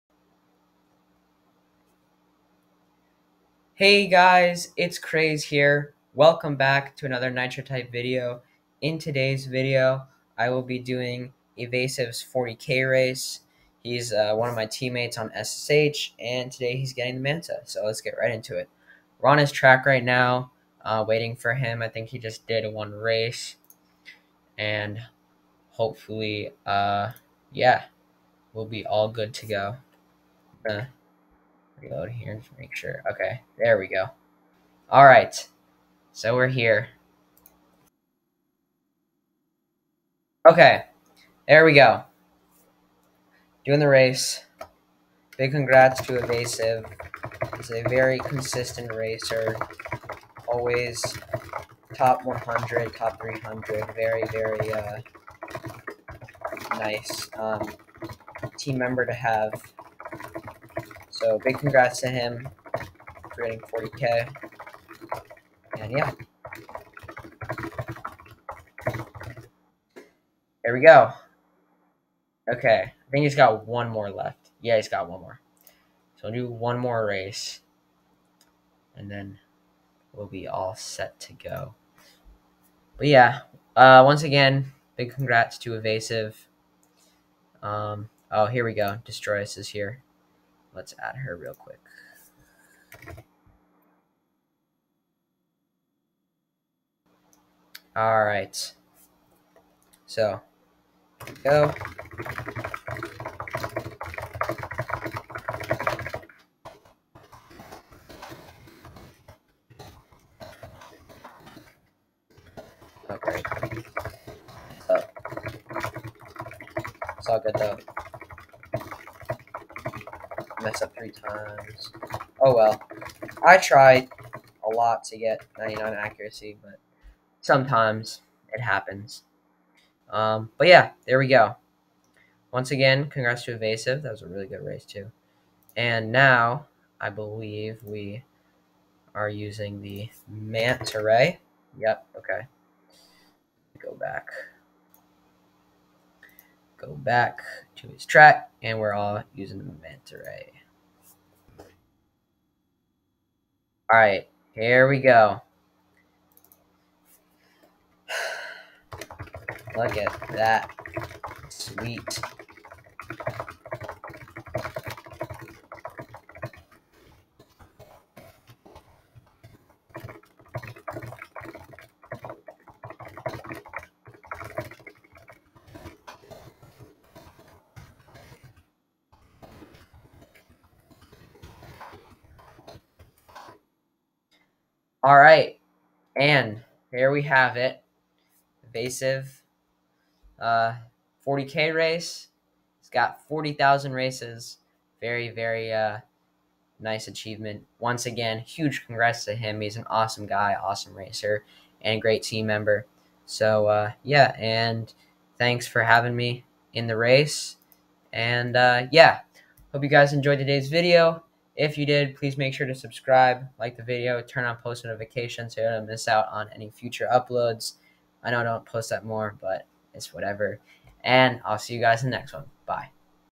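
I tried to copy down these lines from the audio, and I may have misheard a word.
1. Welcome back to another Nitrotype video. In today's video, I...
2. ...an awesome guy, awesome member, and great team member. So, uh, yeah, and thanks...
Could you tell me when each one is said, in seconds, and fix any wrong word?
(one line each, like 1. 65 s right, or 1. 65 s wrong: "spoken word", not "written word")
1. 6 s right
2. 199 s wrong: "racer", not "member".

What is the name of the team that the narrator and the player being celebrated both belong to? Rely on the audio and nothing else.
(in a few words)
SSH.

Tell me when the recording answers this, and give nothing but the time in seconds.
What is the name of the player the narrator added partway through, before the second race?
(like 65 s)
89 s.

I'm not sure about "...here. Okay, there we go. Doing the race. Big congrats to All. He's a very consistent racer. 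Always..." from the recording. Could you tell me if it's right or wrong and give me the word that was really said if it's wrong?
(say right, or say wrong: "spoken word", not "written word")
wrong: "Evasive", not "All".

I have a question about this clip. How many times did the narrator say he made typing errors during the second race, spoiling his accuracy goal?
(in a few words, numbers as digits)
3.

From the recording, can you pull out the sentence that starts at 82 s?
But yeah, uh, once again, big congrats to Evasive.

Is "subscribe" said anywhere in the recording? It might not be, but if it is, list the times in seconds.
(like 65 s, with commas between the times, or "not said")
212 s.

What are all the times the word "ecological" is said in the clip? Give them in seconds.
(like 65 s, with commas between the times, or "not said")
not said.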